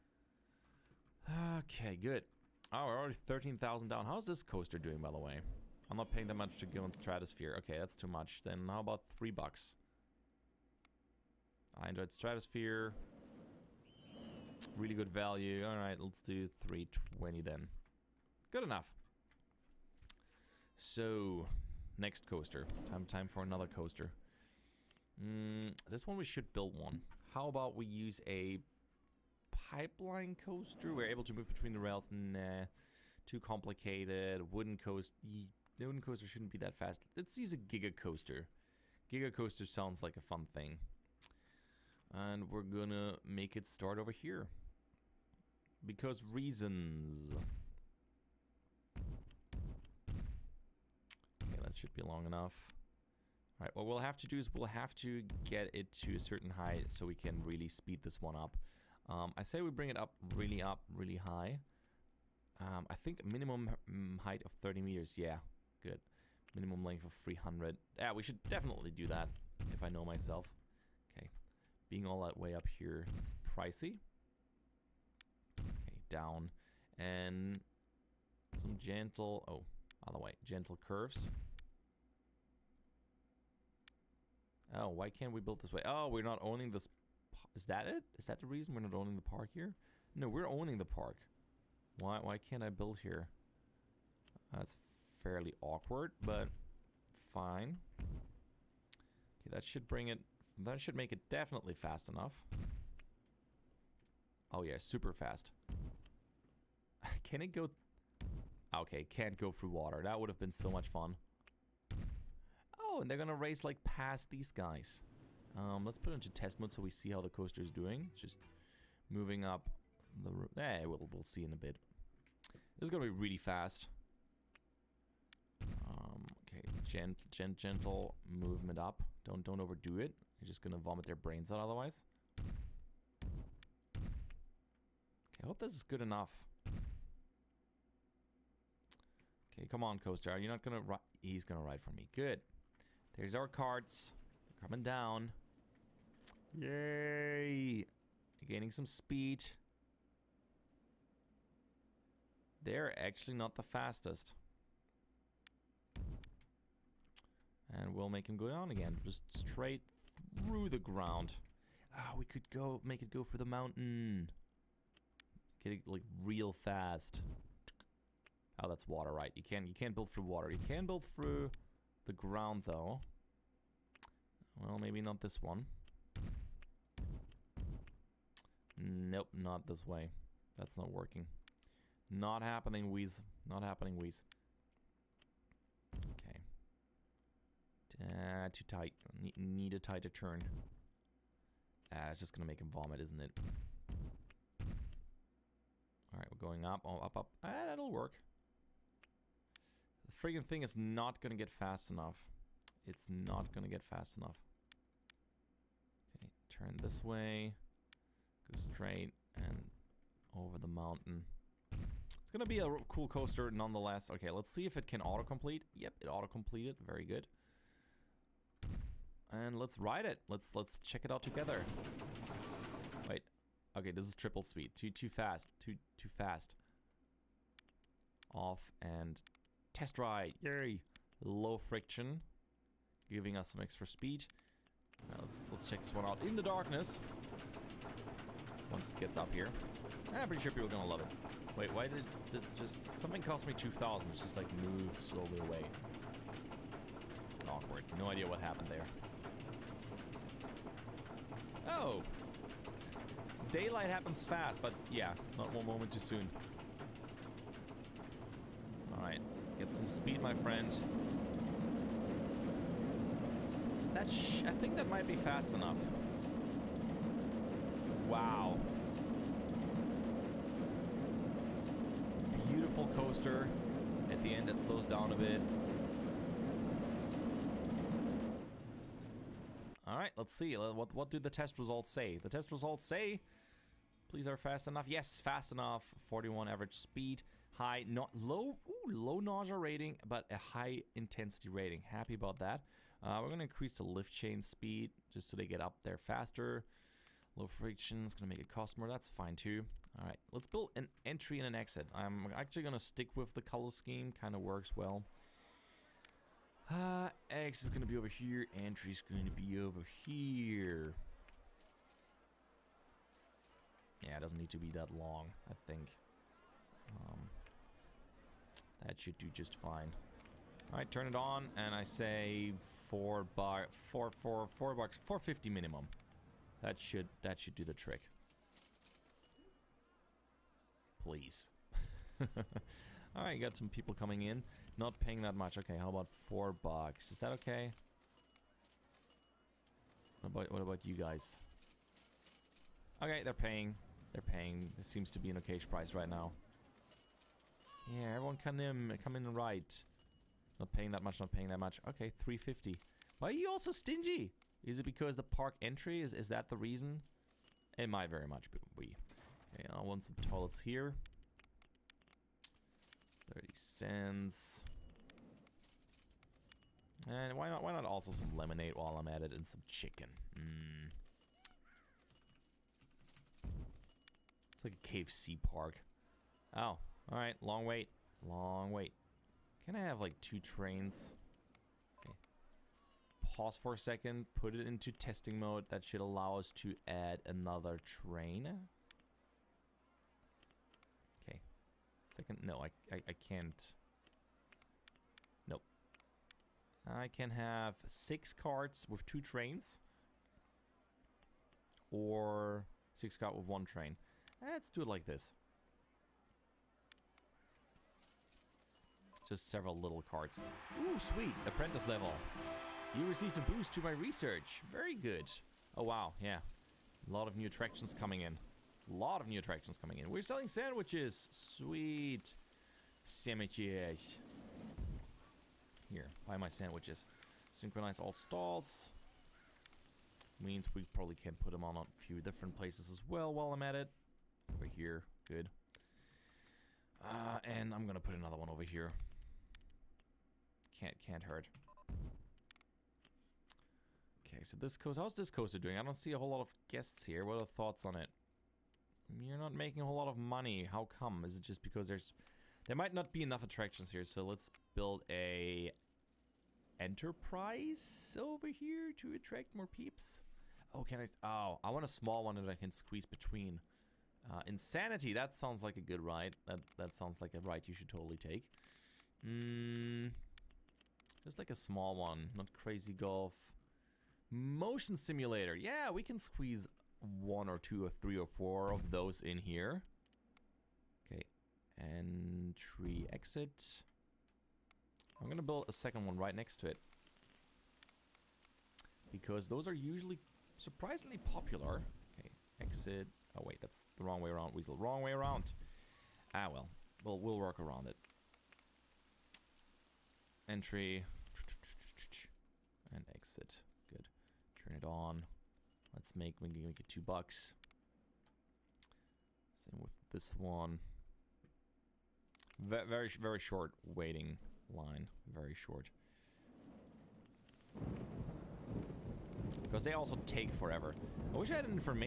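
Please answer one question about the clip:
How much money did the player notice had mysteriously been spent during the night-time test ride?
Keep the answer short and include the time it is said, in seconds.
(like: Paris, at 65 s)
2,000, at 243 s.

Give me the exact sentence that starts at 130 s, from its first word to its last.
You're just going to vomit their brains out otherwise.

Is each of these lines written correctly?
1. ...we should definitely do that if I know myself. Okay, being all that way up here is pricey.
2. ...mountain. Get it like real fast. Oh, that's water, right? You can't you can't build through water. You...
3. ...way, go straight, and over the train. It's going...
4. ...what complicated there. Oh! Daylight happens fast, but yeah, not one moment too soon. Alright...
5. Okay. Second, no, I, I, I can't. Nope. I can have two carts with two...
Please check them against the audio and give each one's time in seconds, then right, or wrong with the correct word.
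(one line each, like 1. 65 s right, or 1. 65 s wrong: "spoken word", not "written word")
1. 68 s right
2. 163 s right
3. 207 s wrong: "mountain", not "train"
4. 248 s wrong: "happened", not "complicated"
5. 391 s wrong: "six", not "two".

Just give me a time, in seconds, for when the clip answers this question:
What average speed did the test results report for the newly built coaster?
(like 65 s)
285 s.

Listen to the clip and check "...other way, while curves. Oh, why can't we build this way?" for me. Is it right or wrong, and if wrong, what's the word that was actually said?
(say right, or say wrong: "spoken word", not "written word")
wrong: "gentle", not "while".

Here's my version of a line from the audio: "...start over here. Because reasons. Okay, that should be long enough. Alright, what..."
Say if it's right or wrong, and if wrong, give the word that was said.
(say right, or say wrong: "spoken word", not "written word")
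right.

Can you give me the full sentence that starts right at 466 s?
That that sounds like a ride you should totally take.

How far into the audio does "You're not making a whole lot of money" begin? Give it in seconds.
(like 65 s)
449 s.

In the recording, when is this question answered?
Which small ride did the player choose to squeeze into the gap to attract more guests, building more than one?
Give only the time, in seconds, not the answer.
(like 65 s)
474 s.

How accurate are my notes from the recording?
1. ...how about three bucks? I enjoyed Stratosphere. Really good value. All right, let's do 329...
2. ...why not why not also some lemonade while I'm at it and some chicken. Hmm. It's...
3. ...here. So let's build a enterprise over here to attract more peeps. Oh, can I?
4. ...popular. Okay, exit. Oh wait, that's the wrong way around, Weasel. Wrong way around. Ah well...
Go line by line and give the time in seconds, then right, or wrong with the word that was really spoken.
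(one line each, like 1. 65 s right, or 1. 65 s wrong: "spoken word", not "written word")
1. 8 s wrong: "320", not "329"
2. 367 s right
3. 453 s right
4. 491 s right.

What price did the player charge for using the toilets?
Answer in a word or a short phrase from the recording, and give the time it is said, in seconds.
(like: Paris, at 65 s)
30 cents, at 363 s.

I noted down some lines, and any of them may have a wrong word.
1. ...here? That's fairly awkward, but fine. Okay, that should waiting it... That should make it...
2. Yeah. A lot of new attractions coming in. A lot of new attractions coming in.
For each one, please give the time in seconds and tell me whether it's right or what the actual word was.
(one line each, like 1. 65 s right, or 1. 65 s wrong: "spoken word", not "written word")
1. 92 s wrong: "bring", not "waiting"
2. 416 s right.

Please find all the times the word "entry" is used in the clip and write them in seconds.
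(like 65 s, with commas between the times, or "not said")
301 s, 308 s, 355 s, 481 s, 500 s.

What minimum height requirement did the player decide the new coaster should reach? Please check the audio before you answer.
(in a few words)
30 meters.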